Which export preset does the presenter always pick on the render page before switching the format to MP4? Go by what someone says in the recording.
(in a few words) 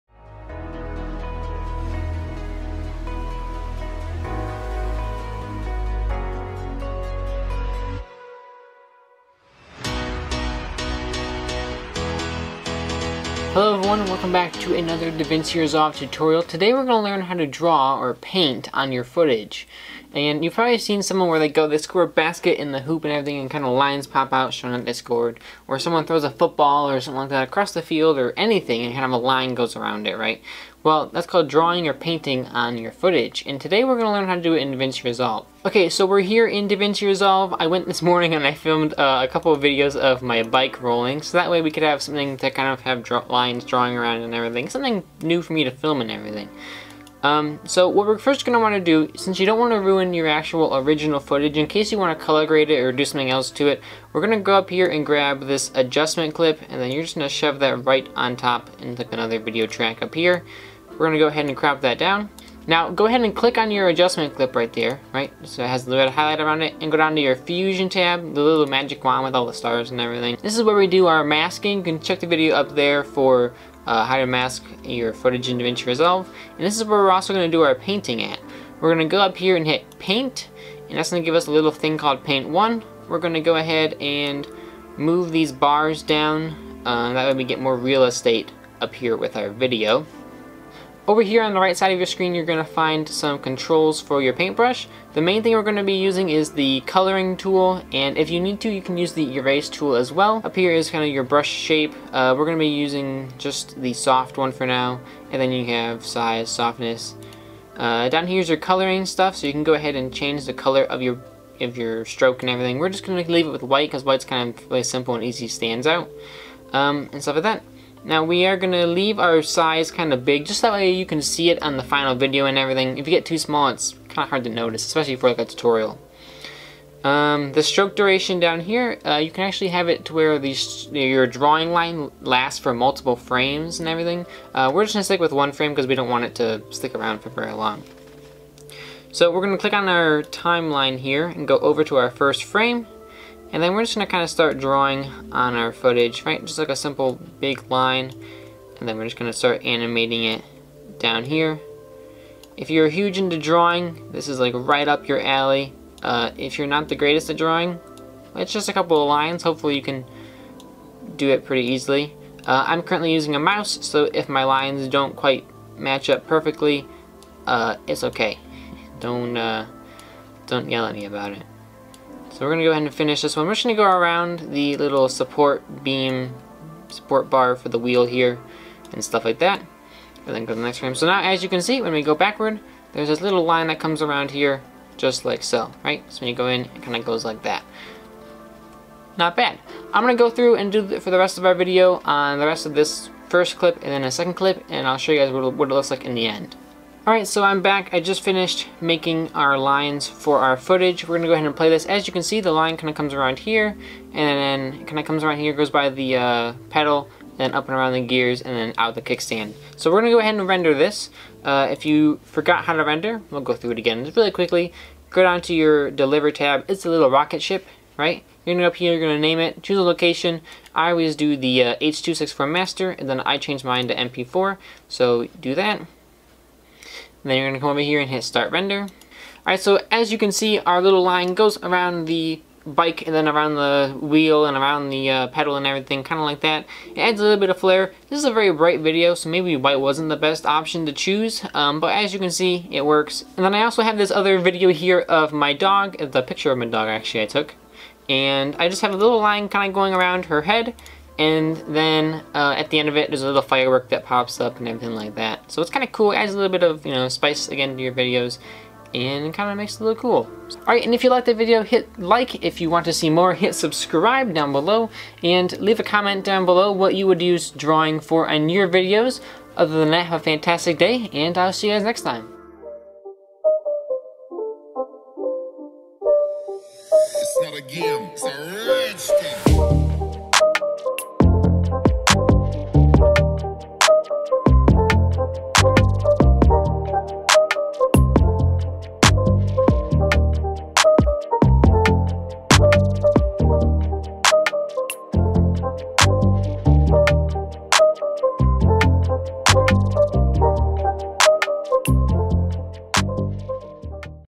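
H.264 master.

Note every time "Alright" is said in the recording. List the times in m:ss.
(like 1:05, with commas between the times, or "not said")
3:17, 3:49, 4:20.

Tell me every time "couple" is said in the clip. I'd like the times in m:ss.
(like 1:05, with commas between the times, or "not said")
0:39, 2:38.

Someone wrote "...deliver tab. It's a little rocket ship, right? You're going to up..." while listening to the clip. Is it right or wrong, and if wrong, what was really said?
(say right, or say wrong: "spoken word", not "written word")
right.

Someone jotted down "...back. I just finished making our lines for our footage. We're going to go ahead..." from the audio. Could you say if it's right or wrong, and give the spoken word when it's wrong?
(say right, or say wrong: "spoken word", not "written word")
right.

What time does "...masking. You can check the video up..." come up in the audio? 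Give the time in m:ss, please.
1:11.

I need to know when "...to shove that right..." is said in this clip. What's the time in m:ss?
0:57.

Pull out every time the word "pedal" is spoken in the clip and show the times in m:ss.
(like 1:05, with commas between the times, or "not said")
3:26, 3:55.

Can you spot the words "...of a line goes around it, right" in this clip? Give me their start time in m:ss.
0:29.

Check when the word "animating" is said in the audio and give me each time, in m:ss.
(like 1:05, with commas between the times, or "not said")
2:29.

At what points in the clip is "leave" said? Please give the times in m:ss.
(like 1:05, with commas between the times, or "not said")
1:53, 1:58, 4:25.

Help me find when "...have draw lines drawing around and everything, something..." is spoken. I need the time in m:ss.
0:42.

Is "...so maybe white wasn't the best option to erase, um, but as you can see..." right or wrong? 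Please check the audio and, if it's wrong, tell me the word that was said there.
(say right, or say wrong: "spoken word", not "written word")
wrong: "choose", not "erase".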